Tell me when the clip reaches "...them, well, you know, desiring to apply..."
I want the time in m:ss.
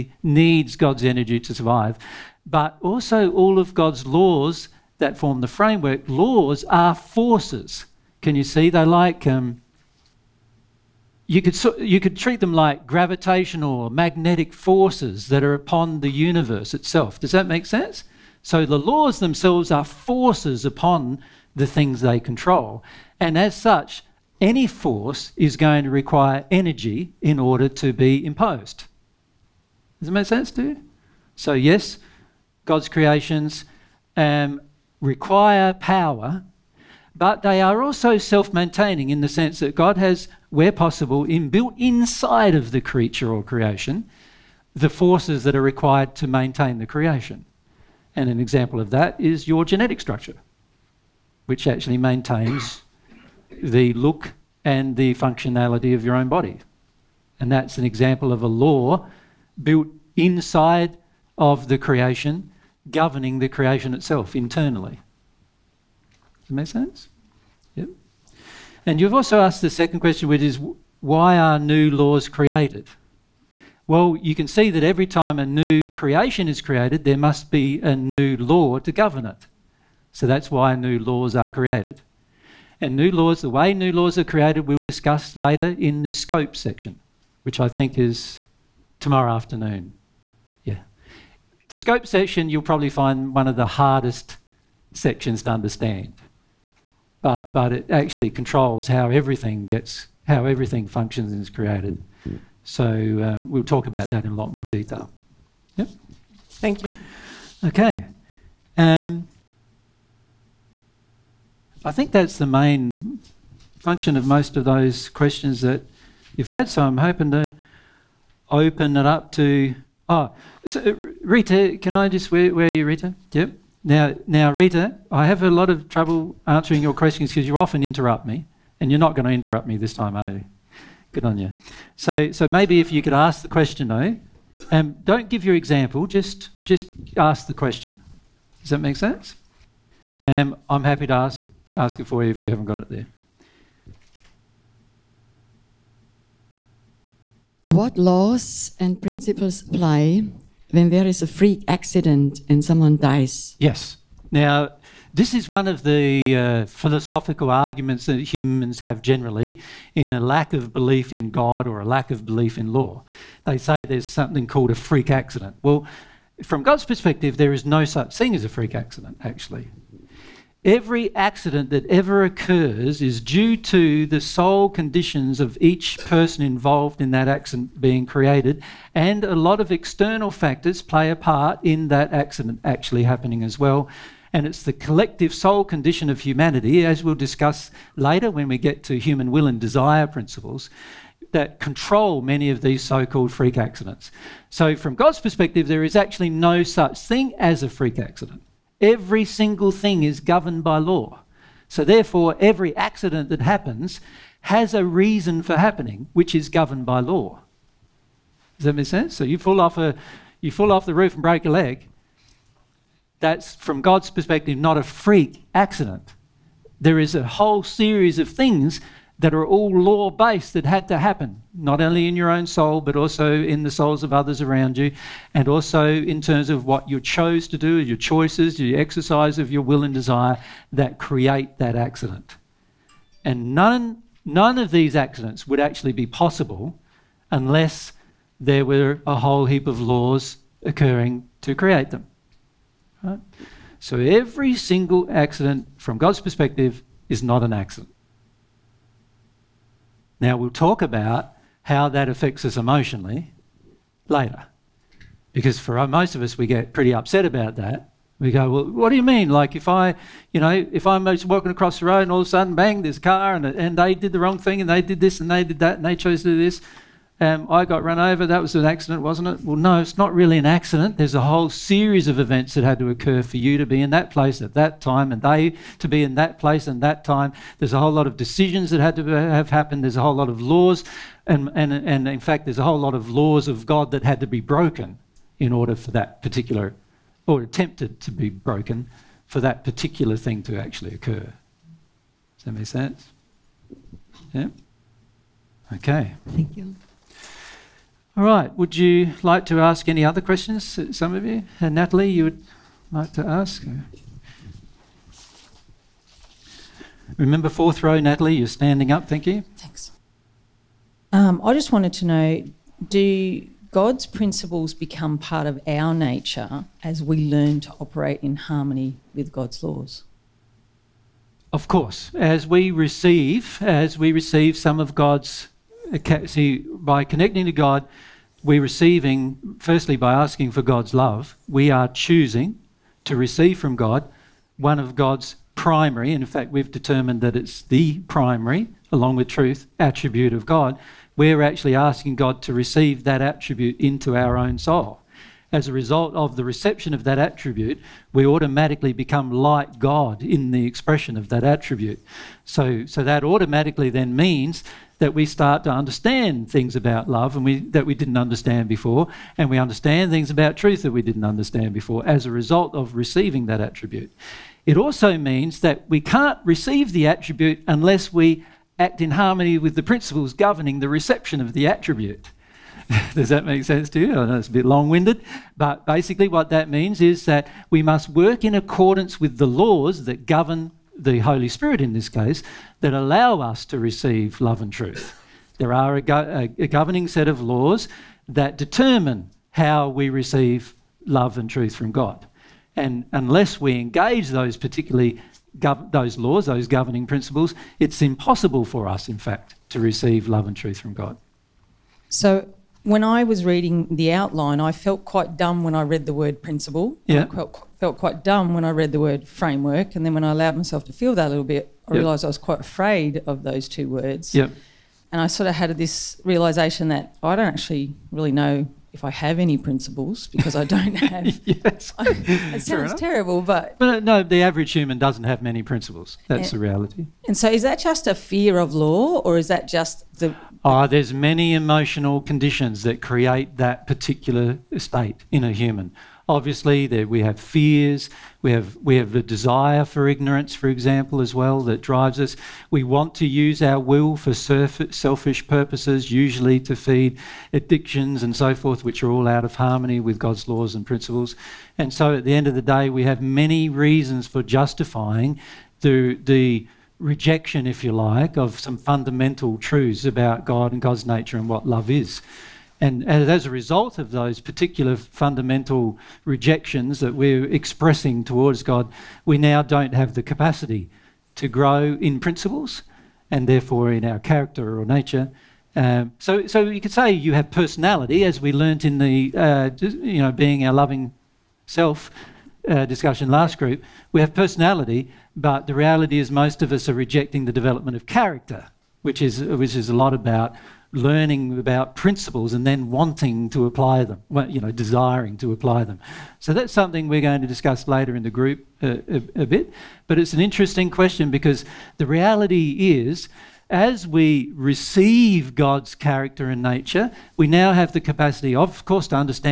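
8:14.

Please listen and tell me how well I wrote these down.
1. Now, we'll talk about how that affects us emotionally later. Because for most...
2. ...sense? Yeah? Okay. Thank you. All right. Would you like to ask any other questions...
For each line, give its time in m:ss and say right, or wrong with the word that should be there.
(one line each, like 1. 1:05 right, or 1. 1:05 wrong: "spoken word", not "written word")
1. 4:10 right
2. 4:52 right.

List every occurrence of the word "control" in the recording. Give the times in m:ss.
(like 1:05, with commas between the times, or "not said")
0:22, 1:38, 3:11.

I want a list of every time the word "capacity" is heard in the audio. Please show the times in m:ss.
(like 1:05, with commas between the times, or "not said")
7:50, 8:27.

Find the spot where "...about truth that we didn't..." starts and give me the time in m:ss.
6:00.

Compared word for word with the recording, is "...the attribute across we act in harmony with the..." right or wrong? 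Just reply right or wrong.
wrong.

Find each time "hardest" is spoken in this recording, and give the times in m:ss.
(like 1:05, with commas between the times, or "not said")
1:33.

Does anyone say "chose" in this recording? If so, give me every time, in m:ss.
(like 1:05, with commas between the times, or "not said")
3:46, 4:25.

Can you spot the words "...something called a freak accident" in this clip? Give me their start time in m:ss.
2:44.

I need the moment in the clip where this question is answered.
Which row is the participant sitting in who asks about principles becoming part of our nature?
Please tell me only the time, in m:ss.
5:07.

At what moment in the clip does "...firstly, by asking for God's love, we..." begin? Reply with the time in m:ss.
5:29.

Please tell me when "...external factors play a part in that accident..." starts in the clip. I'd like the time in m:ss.
2:59.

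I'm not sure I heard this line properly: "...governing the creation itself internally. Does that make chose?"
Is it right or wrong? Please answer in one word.
wrong.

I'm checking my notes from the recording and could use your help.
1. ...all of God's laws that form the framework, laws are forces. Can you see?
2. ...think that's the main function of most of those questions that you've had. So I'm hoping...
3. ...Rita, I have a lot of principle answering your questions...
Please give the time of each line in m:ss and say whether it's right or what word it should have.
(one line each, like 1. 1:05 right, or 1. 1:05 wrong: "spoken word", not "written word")
1. 0:03 right
2. 1:51 right
3. 2:04 wrong: "trouble", not "principle".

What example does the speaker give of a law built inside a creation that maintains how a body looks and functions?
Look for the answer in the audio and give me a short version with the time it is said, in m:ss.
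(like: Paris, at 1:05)
genetic structure, at 0:49.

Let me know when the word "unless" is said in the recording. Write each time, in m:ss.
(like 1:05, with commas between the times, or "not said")
3:57, 6:07, 6:33.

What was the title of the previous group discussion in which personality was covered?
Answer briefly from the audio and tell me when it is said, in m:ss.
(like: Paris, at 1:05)
being our loving self, at 8:00.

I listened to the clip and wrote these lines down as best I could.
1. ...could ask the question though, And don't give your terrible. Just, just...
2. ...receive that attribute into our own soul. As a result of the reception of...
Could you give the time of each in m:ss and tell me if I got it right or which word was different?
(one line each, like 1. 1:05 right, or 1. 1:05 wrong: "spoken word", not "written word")
1. 2:13 wrong: "example", not "terrible"
2. 5:42 right.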